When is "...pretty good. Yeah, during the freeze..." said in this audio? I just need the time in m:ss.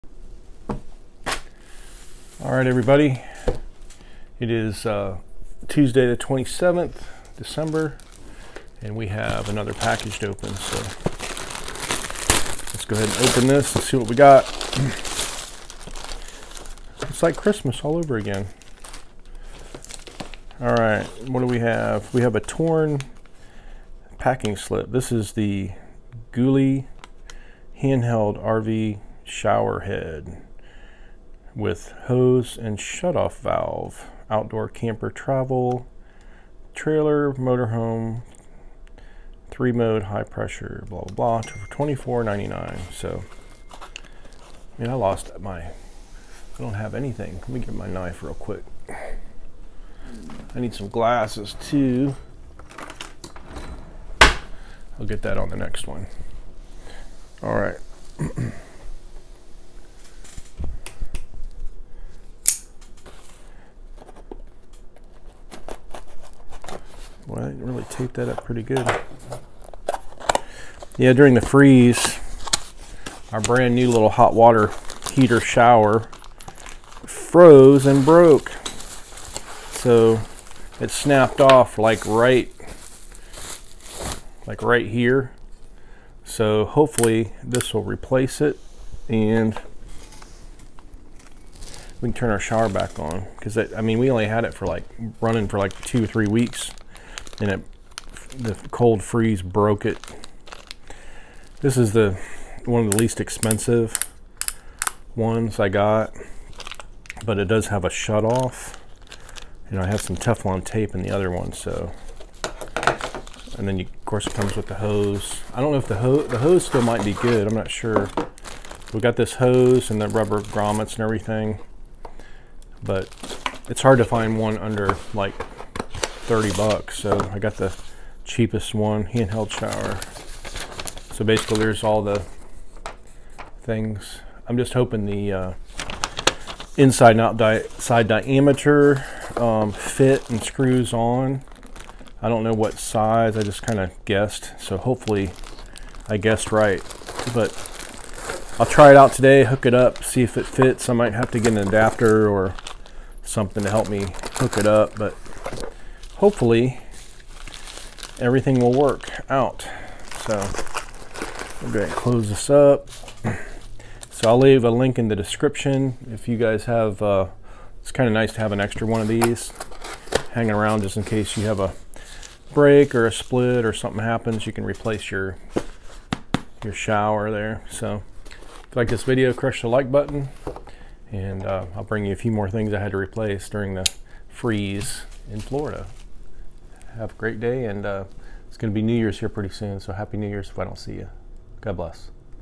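1:08.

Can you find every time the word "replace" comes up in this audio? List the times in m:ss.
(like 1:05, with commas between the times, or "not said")
1:27, 2:54, 3:02.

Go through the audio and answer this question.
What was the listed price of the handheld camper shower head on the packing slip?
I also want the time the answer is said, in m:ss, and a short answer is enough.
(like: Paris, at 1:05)
$24.99, at 0:41.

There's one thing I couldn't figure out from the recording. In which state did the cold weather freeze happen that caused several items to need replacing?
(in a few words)
Florida.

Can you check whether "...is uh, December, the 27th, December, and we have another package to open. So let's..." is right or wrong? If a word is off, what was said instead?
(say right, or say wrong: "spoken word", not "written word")
wrong: "Tuesday", not "December".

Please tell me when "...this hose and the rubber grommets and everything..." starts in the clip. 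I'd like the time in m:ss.
1:59.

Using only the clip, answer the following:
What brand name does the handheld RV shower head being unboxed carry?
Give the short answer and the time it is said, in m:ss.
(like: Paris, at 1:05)
Ghoulie, at 0:26.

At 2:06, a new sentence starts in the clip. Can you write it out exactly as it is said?
So I got the cheapest one, handheld shower.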